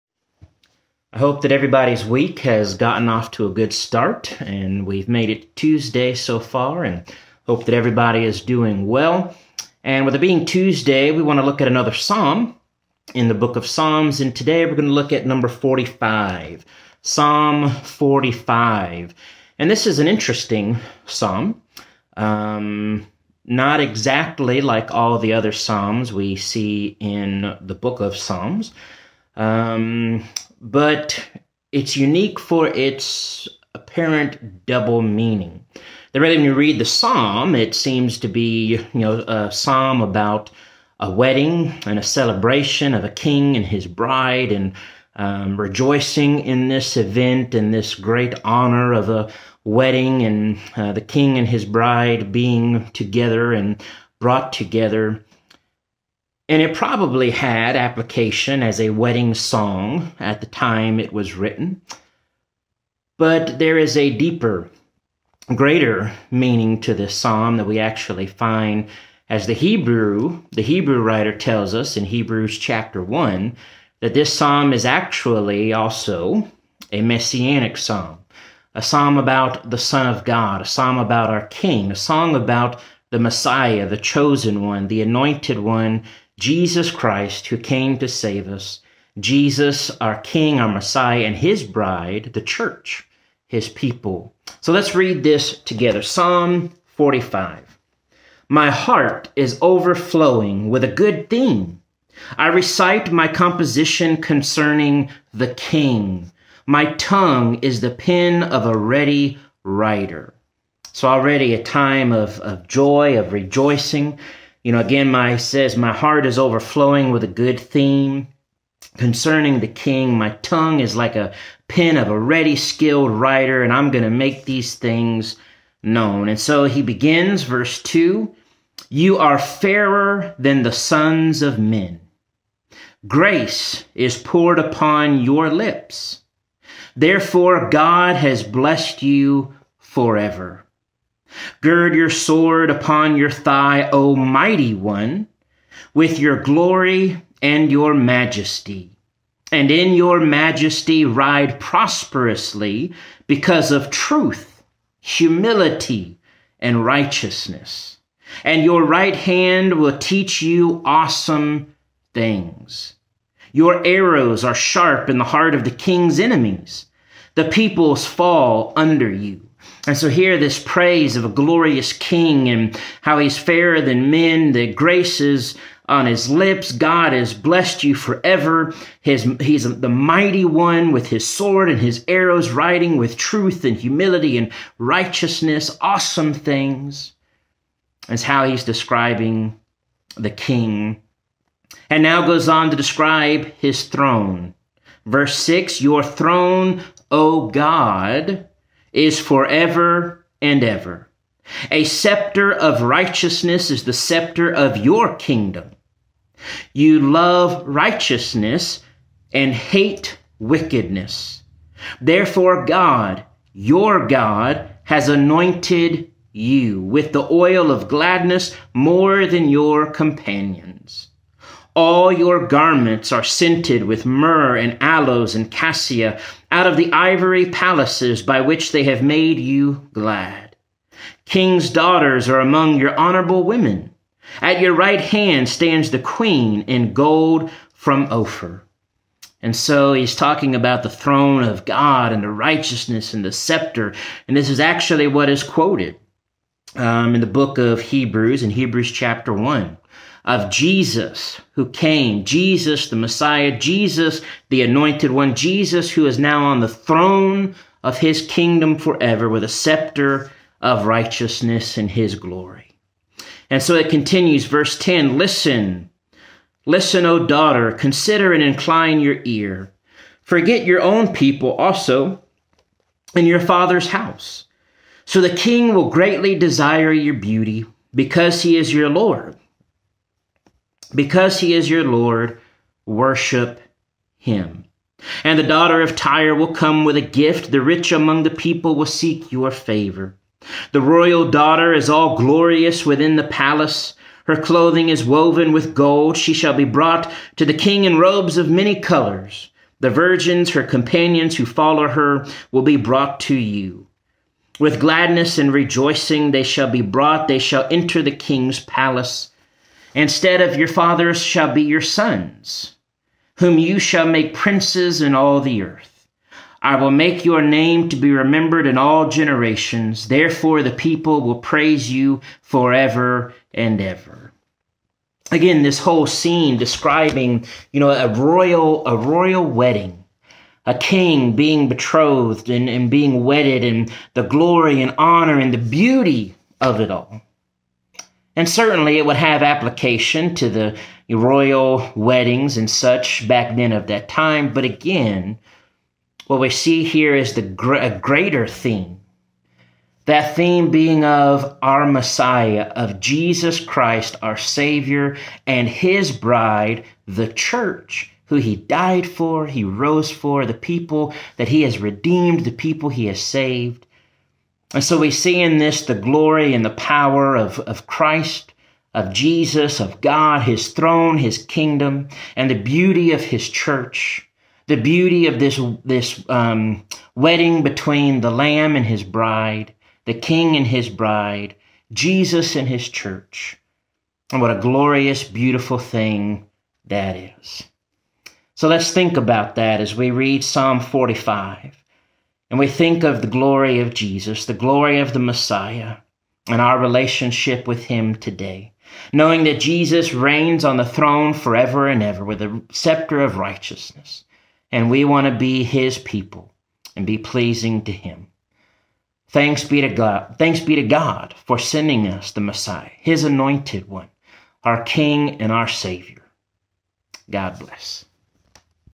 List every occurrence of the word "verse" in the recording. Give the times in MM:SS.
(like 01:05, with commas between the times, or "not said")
02:07, 03:15, 04:24.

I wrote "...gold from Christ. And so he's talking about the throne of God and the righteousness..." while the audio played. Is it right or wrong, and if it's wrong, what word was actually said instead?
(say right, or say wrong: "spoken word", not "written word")
wrong: "Ophir", not "Christ".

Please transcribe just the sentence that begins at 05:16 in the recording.
I will make your name to be remembered in all generations.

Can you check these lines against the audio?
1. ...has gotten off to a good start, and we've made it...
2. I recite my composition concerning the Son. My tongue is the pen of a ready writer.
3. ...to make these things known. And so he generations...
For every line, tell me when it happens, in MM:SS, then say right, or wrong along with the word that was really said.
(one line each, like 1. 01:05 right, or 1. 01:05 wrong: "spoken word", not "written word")
1. 00:02 right
2. 01:42 wrong: "King", not "Son"
3. 02:04 wrong: "begins", not "generations".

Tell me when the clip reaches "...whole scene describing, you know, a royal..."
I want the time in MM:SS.
05:25.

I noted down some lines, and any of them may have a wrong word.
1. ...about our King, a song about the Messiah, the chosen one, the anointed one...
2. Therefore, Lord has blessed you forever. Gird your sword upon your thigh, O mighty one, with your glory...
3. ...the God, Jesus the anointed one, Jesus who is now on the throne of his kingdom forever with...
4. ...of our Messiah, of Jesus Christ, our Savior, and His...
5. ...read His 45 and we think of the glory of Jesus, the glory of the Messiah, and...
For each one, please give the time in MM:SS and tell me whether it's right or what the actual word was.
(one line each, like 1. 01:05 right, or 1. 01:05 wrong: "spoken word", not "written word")
1. 01:20 right
2. 02:16 wrong: "God", not "Lord"
3. 04:12 wrong: "Messiah", not "God"
4. 05:51 right
5. 06:30 wrong: "Psalm", not "His".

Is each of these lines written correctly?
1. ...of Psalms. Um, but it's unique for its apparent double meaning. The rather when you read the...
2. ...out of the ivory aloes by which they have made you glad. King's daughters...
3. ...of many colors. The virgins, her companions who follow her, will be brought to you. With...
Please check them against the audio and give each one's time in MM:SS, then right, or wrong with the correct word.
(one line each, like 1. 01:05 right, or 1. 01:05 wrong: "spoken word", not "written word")
1. 00:27 right
2. 03:46 wrong: "palaces", not "aloes"
3. 04:58 right.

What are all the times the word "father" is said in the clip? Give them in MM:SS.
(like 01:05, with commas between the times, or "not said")
04:33, 05:10.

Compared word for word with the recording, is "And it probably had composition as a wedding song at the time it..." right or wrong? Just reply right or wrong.
wrong.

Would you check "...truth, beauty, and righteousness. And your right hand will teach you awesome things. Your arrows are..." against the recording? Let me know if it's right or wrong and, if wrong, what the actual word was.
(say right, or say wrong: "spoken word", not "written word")
wrong: "humility", not "beauty".